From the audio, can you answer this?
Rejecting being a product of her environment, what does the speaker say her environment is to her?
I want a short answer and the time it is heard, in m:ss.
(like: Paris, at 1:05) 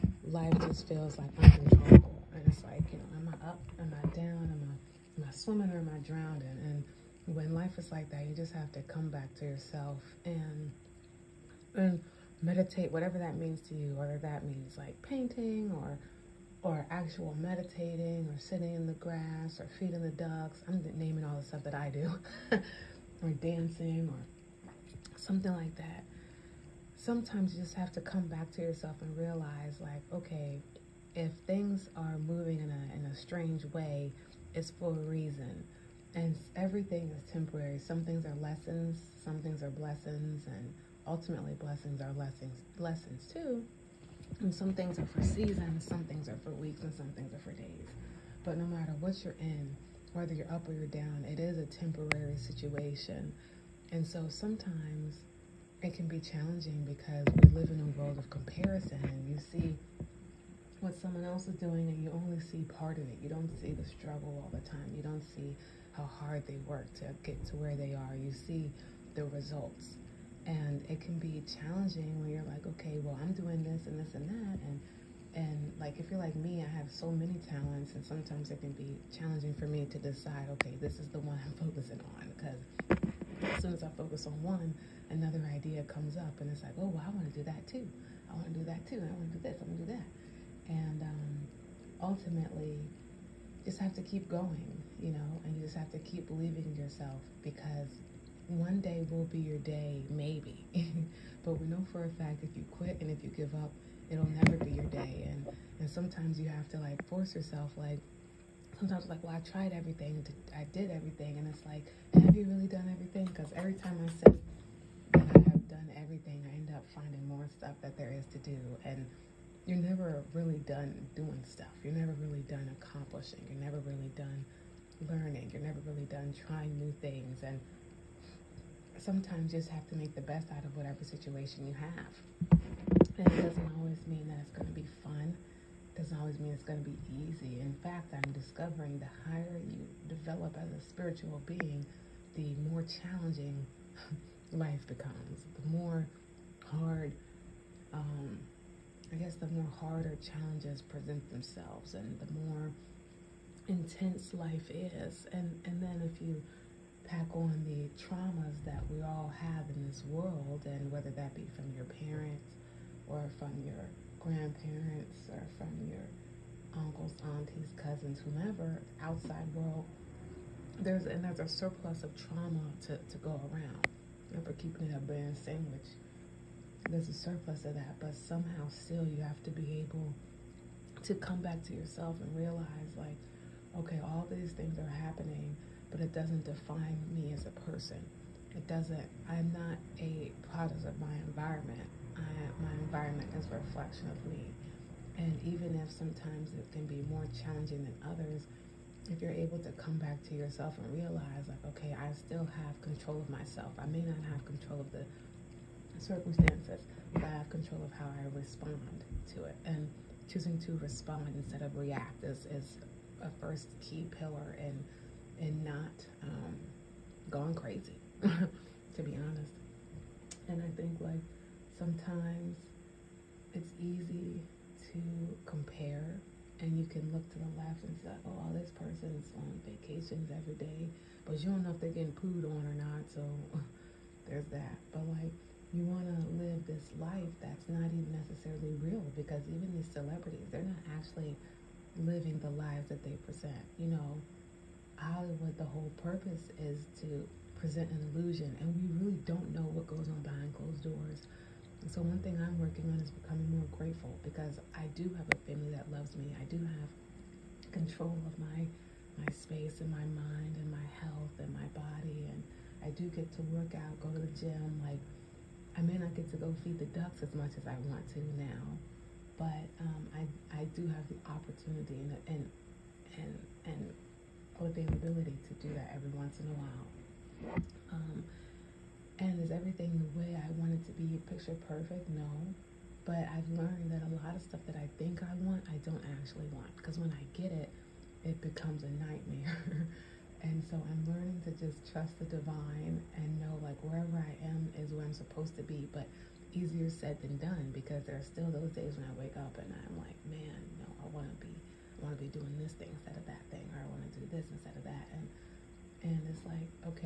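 a reflection, at 3:13.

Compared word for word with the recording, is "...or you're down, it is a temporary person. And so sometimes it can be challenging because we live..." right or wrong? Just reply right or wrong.
wrong.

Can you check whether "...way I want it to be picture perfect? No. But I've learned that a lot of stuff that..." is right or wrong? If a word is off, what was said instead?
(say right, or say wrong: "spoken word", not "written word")
right.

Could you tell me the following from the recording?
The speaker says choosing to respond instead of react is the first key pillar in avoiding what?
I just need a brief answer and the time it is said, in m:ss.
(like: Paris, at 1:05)
going crazy, at 3:37.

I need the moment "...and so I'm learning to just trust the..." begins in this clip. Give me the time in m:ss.
4:50.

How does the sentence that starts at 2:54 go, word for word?
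Remember keeping it a band sandwich.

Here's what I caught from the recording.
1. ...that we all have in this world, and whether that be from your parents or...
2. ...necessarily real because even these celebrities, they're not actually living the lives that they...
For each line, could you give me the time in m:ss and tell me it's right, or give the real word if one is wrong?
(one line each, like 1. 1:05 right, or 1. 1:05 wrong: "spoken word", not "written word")
1. 2:38 right
2. 3:58 right.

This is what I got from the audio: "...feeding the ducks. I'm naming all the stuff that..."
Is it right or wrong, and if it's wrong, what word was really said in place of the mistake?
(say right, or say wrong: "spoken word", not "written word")
right.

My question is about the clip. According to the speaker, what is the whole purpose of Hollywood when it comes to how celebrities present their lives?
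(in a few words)
to present an illusion.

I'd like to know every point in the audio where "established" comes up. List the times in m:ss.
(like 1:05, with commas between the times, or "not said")
not said.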